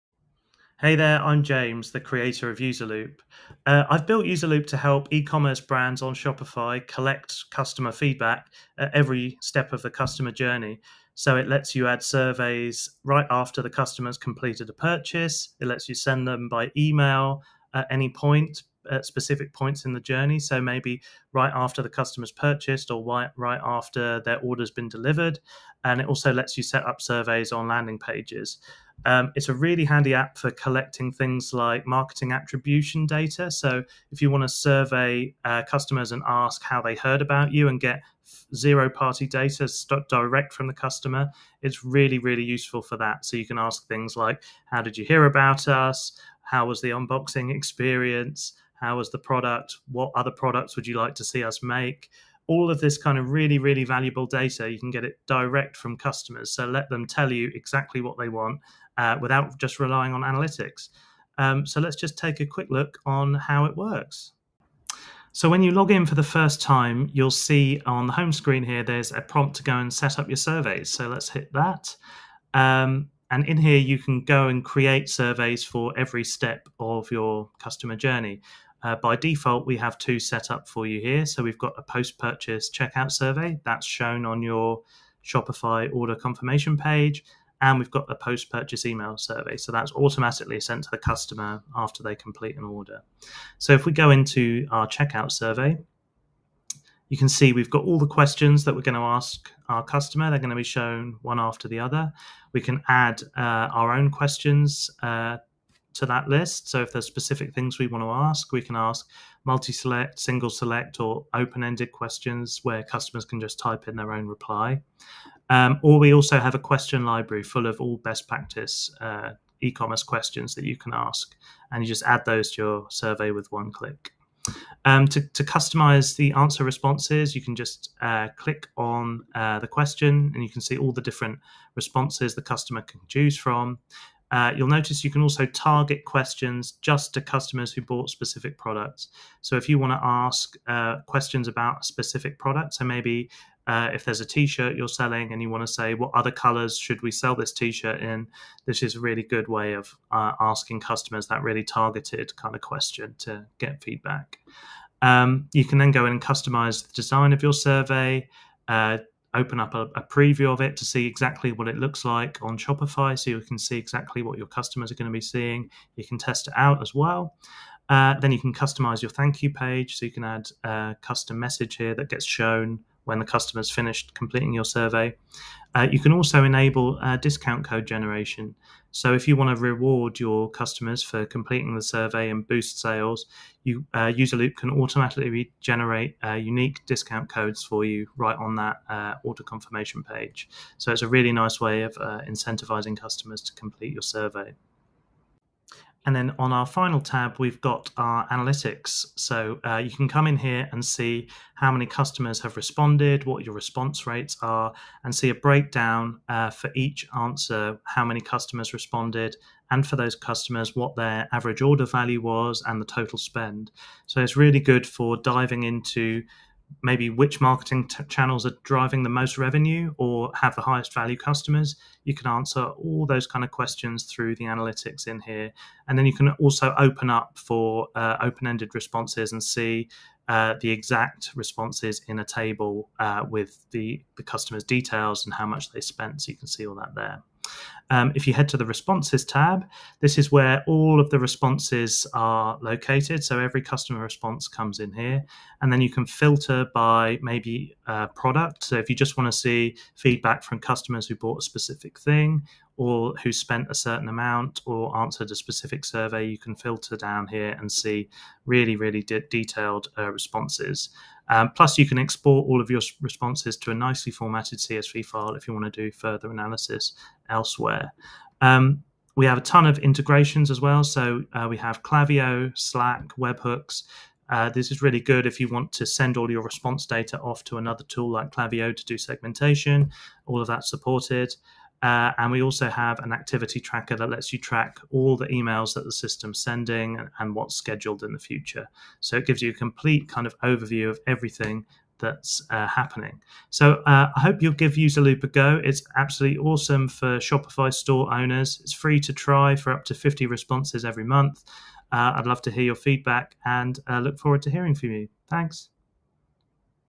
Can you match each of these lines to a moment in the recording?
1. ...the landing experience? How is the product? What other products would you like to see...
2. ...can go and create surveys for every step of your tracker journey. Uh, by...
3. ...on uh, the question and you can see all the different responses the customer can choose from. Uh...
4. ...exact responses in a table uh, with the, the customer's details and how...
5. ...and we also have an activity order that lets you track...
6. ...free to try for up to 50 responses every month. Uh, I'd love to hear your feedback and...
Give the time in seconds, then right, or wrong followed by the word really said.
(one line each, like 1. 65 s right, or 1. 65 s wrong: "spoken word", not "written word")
1. 46 s wrong: "unboxing", not "landing"
2. 73 s wrong: "customer", not "tracker"
3. 128 s right
4. 230 s right
5. 282 s wrong: "tracker", not "order"
6. 298 s right.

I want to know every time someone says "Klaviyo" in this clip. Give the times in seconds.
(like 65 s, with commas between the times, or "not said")
271 s, 278 s.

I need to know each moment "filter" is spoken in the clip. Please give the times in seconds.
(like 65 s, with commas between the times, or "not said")
246 s, 256 s.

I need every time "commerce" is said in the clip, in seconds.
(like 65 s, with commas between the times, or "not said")
5 s, 119 s.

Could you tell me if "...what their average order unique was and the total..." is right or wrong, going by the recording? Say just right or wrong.
wrong.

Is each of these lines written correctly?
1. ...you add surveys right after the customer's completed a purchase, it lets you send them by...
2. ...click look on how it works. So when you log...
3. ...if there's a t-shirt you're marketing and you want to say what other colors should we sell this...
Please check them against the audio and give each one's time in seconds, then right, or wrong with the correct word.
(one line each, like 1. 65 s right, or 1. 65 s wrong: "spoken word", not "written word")
1. 11 s right
2. 62 s wrong: "quick", not "click"
3. 143 s wrong: "selling", not "marketing".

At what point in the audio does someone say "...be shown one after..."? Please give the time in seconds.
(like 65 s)
100 s.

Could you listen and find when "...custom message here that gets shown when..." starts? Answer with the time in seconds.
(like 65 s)
171 s.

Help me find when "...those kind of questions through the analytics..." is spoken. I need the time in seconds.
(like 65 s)
223 s.